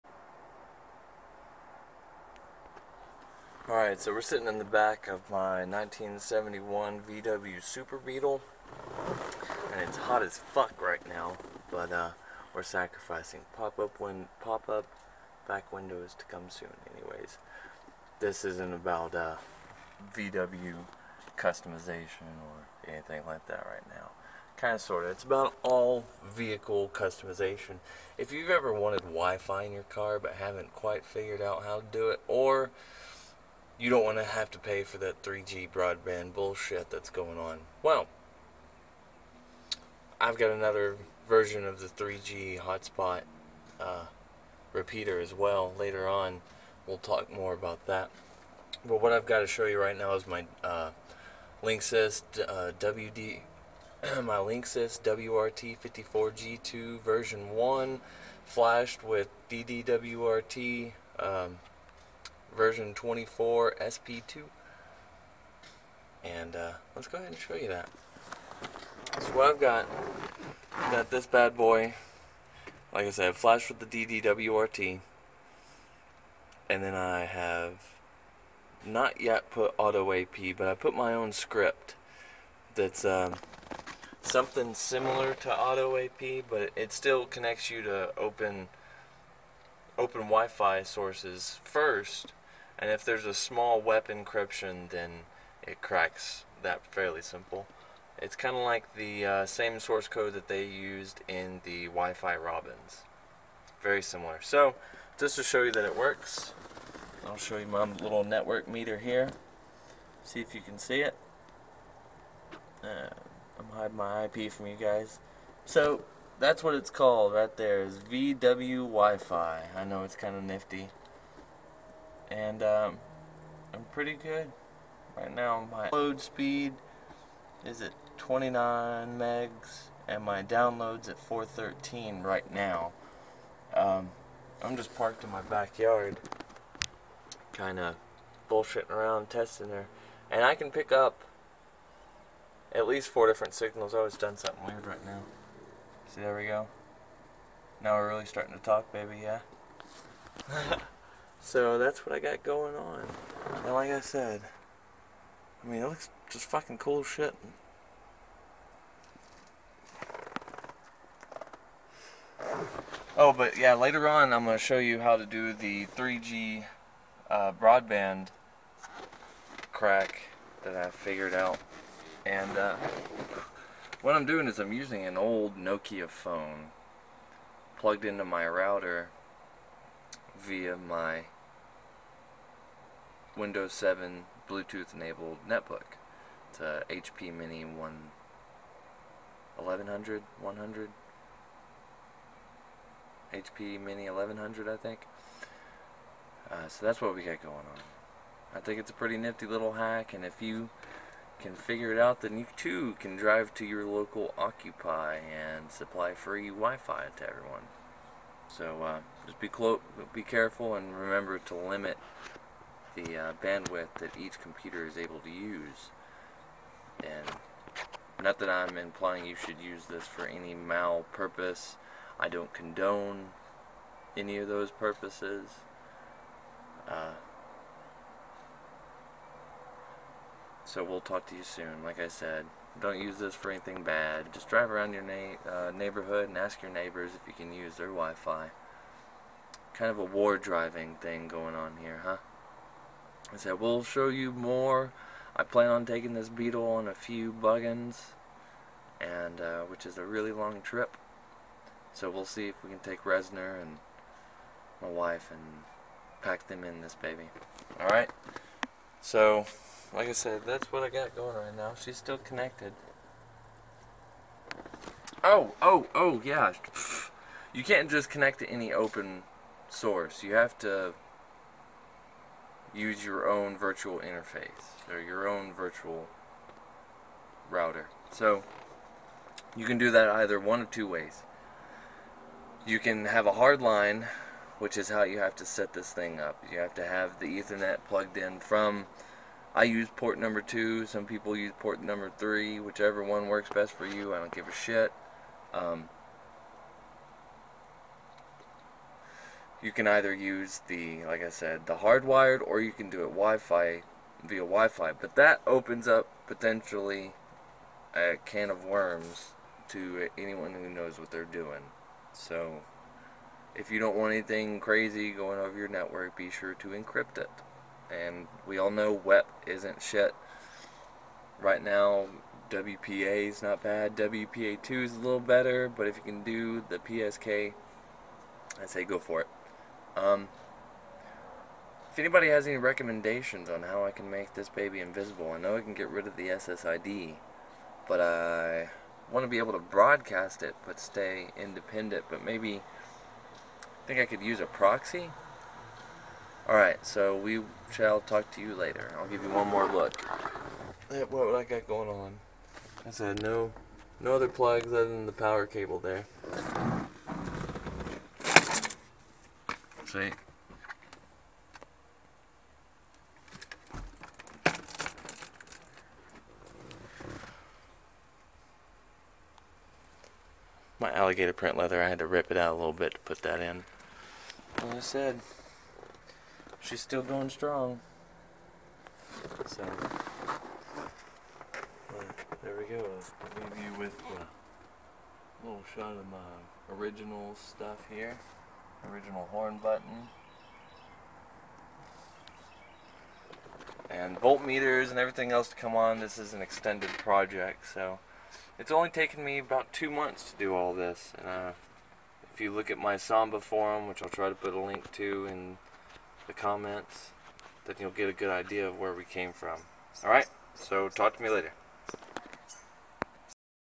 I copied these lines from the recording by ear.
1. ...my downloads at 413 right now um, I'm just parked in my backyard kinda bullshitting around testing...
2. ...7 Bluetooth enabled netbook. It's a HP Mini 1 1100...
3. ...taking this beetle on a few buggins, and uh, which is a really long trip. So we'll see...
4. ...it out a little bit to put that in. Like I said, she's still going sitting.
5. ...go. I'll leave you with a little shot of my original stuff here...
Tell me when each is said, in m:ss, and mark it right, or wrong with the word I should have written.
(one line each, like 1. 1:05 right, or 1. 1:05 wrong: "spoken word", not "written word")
1. 2:10 right
2. 3:03 right
3. 4:05 right
4. 6:12 wrong: "strong", not "sitting"
5. 6:22 right.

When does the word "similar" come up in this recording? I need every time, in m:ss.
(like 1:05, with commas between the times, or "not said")
1:24, 1:44.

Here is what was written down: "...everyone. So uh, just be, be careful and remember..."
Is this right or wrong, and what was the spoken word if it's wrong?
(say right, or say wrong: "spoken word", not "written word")
right.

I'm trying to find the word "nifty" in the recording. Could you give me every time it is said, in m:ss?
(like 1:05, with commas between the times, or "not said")
2:00, 3:19.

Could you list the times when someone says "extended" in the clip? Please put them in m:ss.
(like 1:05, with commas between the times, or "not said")
6:36.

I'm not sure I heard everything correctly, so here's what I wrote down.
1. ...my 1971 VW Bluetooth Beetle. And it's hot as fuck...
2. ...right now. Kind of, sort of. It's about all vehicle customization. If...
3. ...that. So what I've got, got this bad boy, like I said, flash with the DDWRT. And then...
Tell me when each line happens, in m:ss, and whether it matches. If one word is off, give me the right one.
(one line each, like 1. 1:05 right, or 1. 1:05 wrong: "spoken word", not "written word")
1. 0:05 wrong: "Super", not "Bluetooth"
2. 0:23 right
3. 1:07 right.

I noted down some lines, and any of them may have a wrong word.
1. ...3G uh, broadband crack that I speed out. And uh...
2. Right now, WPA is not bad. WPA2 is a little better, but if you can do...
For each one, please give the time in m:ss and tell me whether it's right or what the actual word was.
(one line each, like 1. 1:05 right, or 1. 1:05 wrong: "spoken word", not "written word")
1. 2:45 wrong: "figured", not "speed"
2. 5:21 right.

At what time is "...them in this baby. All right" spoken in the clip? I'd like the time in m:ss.
4:16.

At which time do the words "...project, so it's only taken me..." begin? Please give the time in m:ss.
6:36.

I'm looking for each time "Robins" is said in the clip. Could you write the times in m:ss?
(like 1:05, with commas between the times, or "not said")
1:42.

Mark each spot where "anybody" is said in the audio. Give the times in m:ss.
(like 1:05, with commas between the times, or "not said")
5:31.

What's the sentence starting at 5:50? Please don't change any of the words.
What would I got going on?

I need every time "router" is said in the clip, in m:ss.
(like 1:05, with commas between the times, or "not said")
2:58, 4:37.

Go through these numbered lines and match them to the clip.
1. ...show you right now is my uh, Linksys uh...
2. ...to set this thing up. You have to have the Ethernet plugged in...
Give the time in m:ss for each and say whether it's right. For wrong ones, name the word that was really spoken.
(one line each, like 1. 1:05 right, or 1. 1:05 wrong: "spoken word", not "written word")
1. 0:49 right
2. 4:45 right.